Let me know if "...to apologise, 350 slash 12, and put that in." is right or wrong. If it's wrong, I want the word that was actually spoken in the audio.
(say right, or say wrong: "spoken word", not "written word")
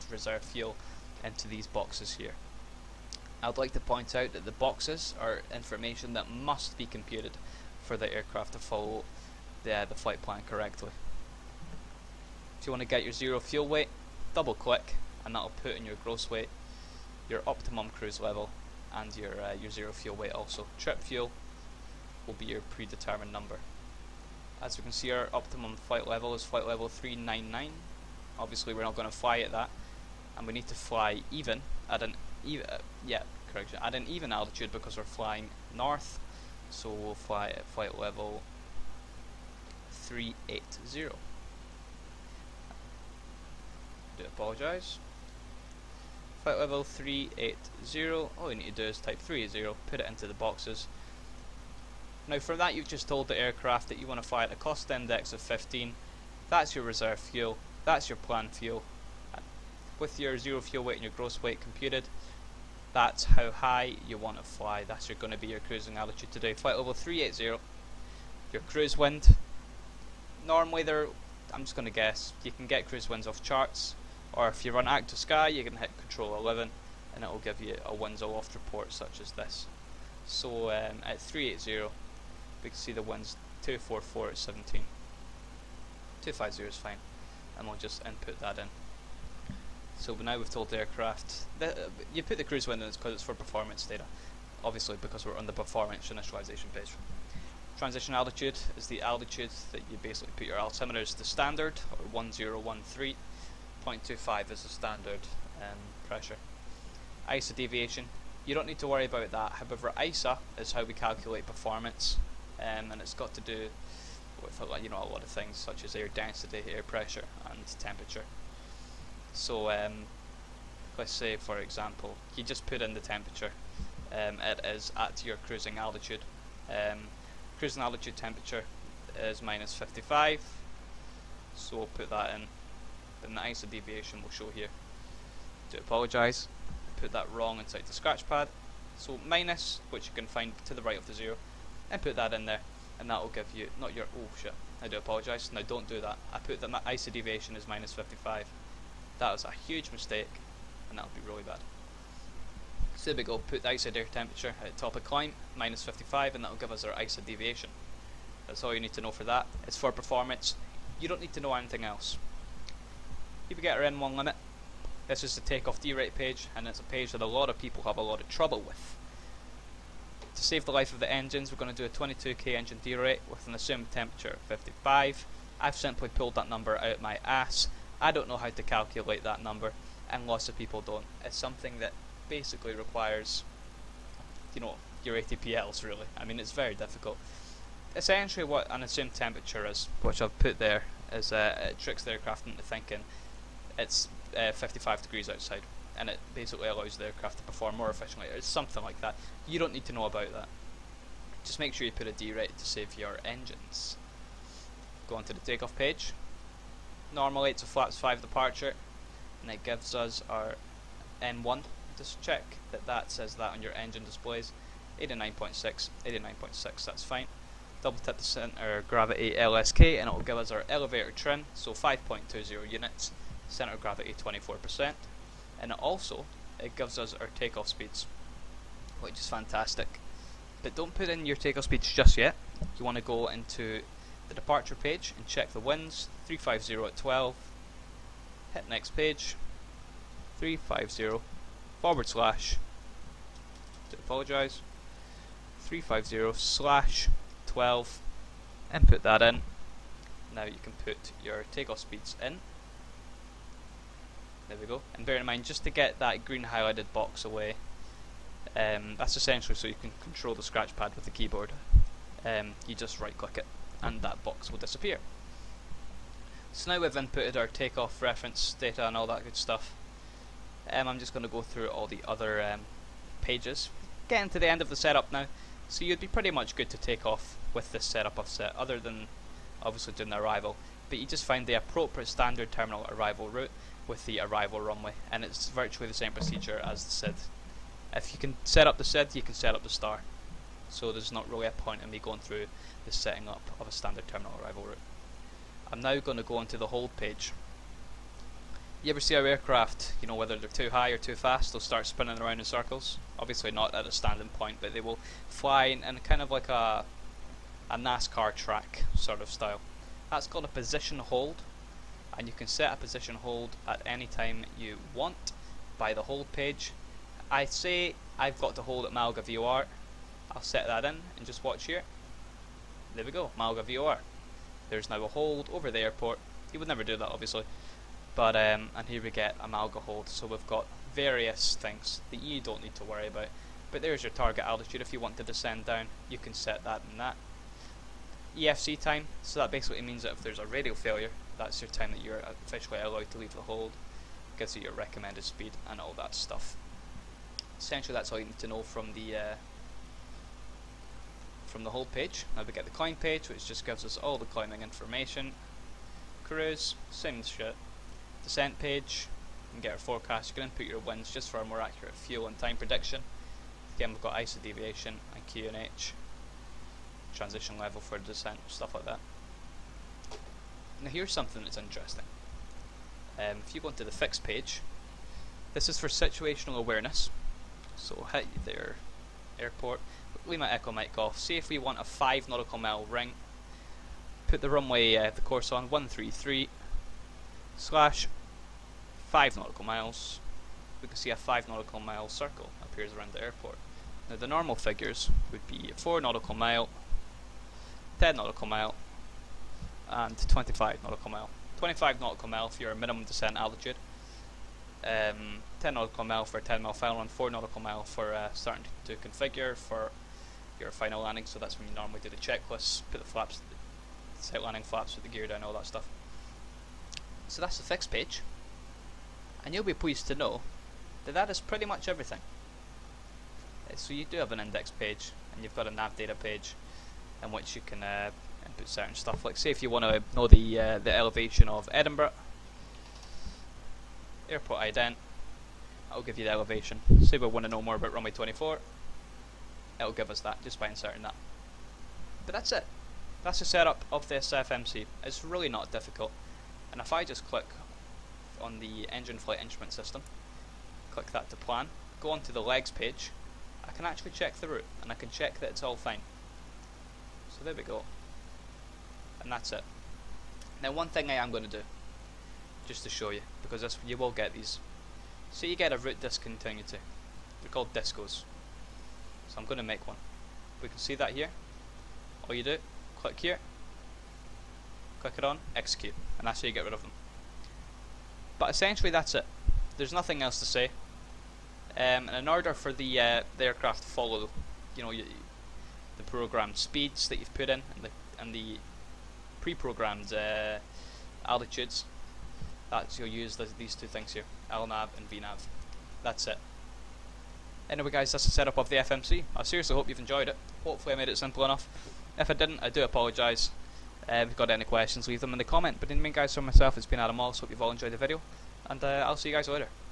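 right.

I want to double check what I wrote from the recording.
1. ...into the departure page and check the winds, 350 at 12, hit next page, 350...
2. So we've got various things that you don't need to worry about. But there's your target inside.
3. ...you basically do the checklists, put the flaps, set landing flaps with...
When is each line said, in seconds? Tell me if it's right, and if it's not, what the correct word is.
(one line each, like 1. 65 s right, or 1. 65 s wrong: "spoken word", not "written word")
1. 233 s right
2. 330 s wrong: "altitude", not "inside"
3. 411 s wrong: "normally", not "basically".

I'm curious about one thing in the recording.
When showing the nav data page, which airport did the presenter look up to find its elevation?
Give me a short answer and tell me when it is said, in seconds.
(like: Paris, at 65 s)
Edinburgh, at 431 s.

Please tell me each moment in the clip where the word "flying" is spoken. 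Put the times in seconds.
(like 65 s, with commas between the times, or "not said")
35 s.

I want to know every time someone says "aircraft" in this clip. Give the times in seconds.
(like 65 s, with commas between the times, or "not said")
8 s, 53 s, 90 s, 192 s, 197 s, 299 s, 483 s.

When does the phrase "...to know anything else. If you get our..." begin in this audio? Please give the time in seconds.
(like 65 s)
161 s.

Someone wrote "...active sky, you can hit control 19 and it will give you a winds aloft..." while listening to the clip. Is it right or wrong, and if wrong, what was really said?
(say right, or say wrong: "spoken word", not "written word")
wrong: "11", not "19".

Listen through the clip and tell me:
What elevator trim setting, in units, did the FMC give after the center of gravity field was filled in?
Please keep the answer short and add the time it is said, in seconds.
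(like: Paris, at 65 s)
5.20, at 221 s.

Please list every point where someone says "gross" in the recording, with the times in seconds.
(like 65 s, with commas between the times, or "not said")
16 s, 61 s.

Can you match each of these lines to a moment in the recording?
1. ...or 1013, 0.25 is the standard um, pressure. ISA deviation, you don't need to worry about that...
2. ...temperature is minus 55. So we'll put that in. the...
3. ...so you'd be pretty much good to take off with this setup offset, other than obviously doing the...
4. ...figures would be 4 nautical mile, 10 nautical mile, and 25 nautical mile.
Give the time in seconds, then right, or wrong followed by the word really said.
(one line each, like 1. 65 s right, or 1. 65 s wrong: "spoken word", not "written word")
1. 101 s right
2. 128 s right
3. 275 s right
4. 394 s right.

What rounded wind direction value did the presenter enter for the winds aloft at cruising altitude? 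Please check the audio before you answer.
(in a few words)
250.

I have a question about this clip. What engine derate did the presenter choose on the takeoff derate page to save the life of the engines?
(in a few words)
22k.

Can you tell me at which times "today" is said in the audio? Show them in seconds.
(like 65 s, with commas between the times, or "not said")
66 s.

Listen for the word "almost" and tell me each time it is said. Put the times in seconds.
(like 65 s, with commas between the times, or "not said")
not said.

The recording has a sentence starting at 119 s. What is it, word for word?
So um, let's say for example, you just put in the temperature.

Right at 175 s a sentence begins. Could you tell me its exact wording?
I've simply pulled that number out my ass I don't know how to calculate that number, and lots of people don't.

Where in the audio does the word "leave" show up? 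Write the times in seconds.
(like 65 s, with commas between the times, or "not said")
343 s, 380 s, 505 s.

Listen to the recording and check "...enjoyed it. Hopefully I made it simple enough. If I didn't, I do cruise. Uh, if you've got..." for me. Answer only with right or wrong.
wrong.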